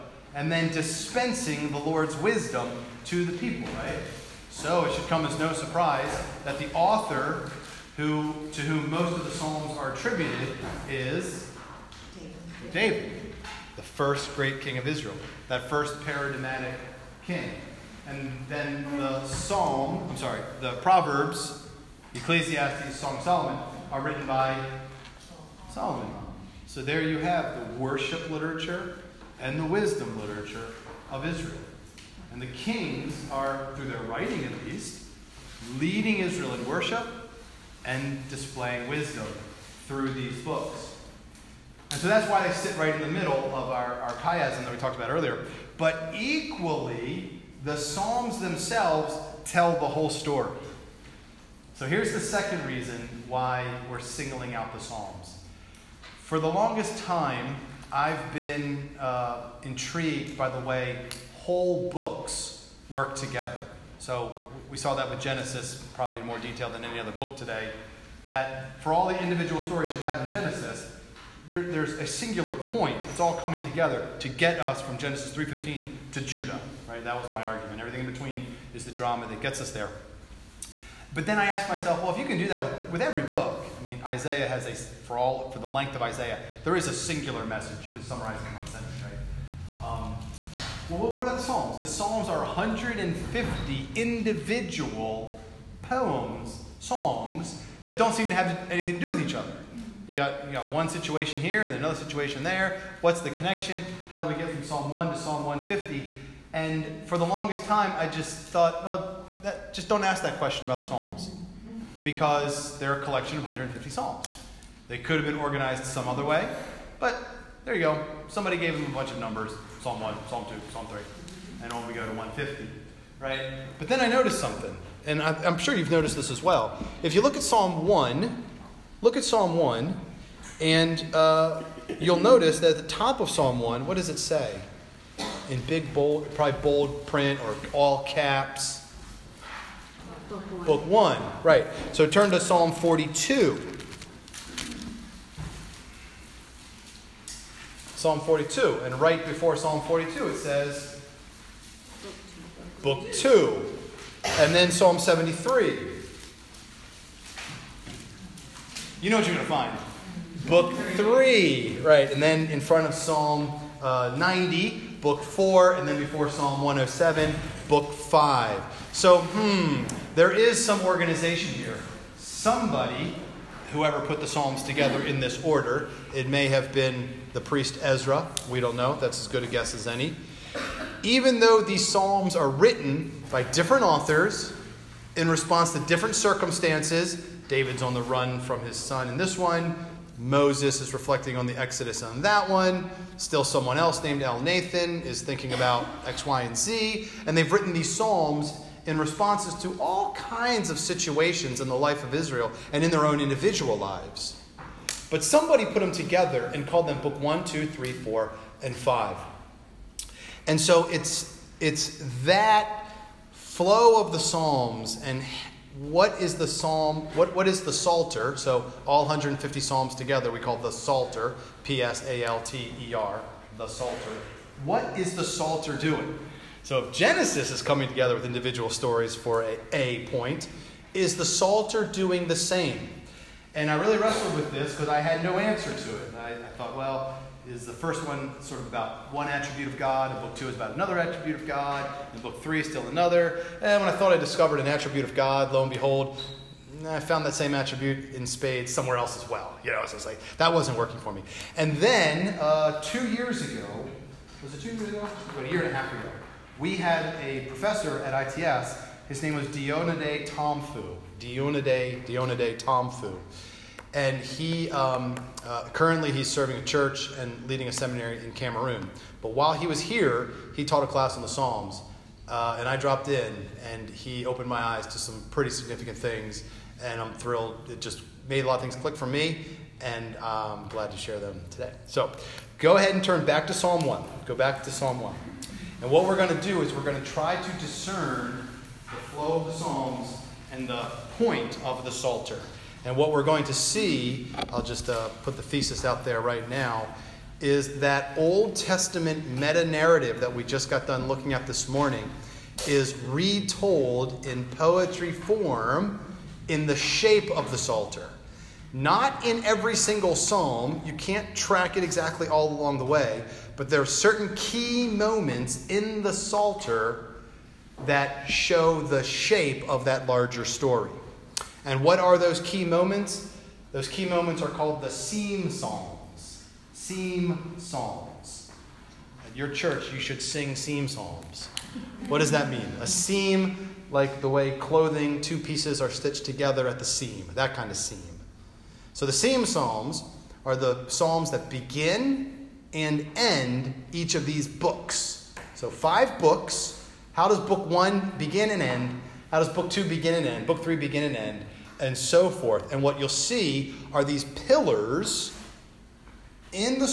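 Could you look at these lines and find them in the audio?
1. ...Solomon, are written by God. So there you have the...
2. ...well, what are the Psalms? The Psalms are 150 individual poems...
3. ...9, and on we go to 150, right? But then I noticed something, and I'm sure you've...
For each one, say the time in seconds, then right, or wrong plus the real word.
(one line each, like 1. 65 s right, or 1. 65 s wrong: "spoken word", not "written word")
1. 23 s wrong: "Solomon", not "God"
2. 90 s right
3. 120 s wrong: "3", not "9".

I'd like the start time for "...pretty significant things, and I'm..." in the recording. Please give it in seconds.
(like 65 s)
275 s.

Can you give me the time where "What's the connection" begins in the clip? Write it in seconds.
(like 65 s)
103 s.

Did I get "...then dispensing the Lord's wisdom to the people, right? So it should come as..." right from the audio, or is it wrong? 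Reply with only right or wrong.
right.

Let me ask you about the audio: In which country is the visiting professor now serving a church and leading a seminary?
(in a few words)
Cameroon.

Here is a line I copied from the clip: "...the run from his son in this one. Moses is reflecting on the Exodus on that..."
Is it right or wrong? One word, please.
right.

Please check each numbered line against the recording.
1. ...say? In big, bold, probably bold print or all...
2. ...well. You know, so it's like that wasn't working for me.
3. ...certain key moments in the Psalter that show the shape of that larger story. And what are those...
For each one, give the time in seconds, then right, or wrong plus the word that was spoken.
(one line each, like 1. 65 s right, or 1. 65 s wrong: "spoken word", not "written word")
1. 134 s right
2. 249 s right
3. 313 s right.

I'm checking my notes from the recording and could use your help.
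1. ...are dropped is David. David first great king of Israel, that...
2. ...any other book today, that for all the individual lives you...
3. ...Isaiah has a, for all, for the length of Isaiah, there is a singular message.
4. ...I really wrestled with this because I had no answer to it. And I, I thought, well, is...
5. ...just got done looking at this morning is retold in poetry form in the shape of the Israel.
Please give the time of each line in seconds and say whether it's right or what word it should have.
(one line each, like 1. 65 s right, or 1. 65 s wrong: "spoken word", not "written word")
1. 9 s wrong: "attributed", not "dropped"
2. 66 s wrong: "stories", not "lives"
3. 84 s right
4. 233 s right
5. 300 s wrong: "Psalter", not "Israel".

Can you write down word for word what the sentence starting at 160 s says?
Book three, right, and then in front of Psalm uh, 90, book four, and then before Psalm 107, book five.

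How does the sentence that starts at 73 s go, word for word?
It's all coming together to get us from Genesis 3.15 to Judah.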